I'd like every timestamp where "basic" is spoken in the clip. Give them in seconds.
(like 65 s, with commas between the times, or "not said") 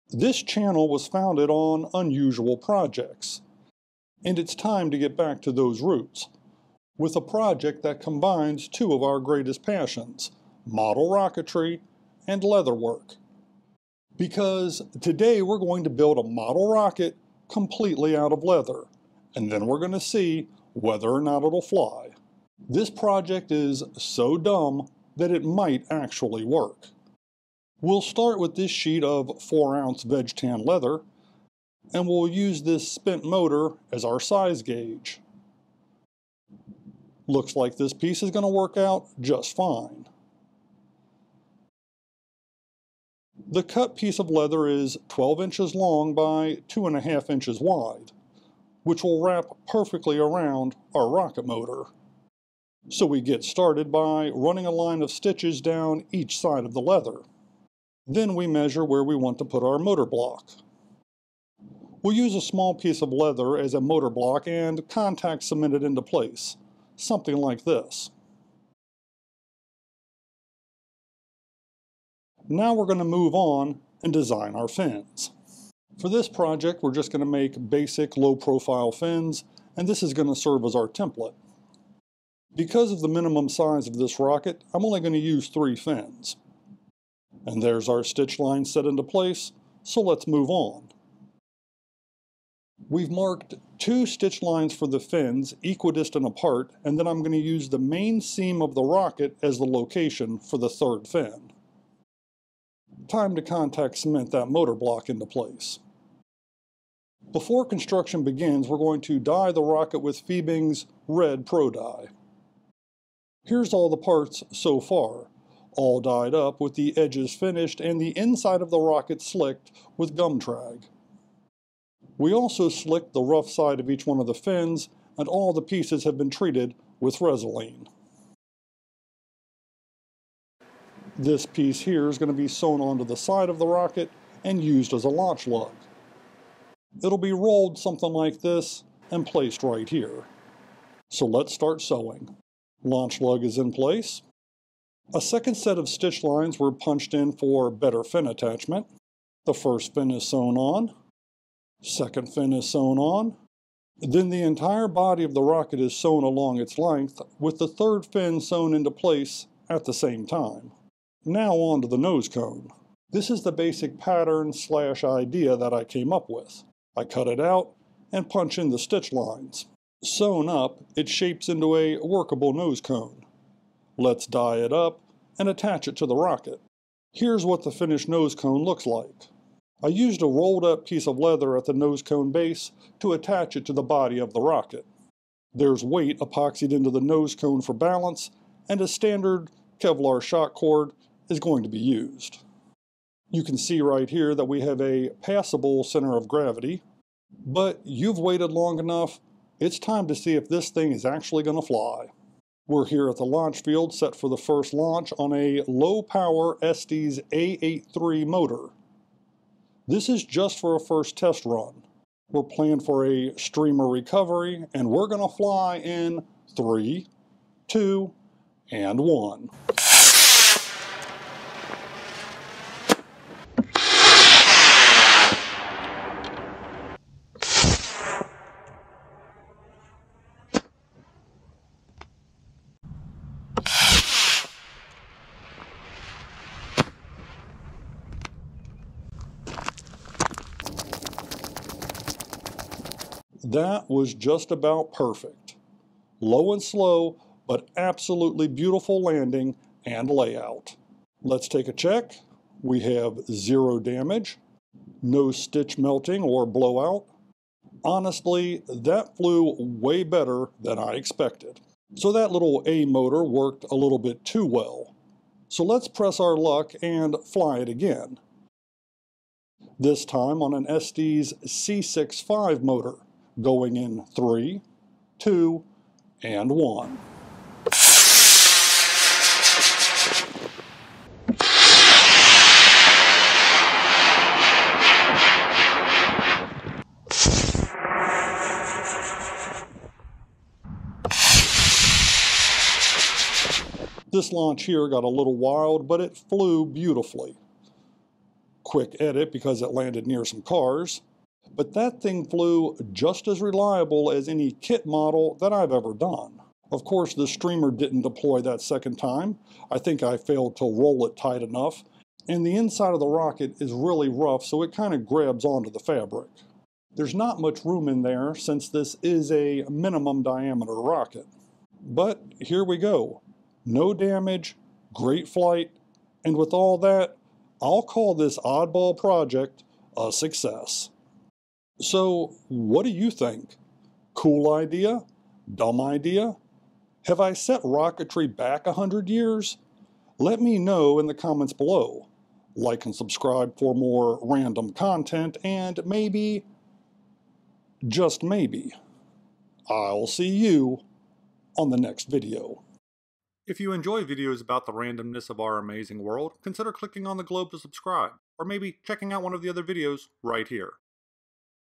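77 s, 163 s.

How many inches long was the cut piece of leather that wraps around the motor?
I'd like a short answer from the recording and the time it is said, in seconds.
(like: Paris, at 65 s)
12 inches, at 45 s.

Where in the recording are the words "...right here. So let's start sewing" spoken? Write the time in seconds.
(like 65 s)
139 s.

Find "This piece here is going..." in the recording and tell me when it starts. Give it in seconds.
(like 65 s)
131 s.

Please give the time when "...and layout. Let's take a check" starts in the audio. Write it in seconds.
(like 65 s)
249 s.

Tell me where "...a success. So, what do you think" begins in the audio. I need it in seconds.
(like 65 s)
329 s.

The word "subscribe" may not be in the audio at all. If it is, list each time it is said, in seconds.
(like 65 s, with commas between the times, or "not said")
342 s, 357 s.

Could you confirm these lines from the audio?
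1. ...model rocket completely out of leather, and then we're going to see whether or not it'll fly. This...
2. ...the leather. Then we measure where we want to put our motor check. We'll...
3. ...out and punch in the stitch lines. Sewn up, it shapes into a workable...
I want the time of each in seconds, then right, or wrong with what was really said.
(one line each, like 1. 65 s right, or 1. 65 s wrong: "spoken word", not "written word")
1. 16 s right
2. 56 s wrong: "block", not "check"
3. 167 s right.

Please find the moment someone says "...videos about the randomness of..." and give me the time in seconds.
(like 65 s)
354 s.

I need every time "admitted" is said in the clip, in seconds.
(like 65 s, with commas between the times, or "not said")
not said.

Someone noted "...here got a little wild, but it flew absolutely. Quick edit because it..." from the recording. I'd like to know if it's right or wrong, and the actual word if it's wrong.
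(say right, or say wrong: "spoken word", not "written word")
wrong: "beautifully", not "absolutely".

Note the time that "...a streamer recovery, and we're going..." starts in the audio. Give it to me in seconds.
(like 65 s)
213 s.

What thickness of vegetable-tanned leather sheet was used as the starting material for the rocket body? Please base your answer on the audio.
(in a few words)
4 ounce.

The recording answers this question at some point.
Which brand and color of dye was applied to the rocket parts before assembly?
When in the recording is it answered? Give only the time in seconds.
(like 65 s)
110 s.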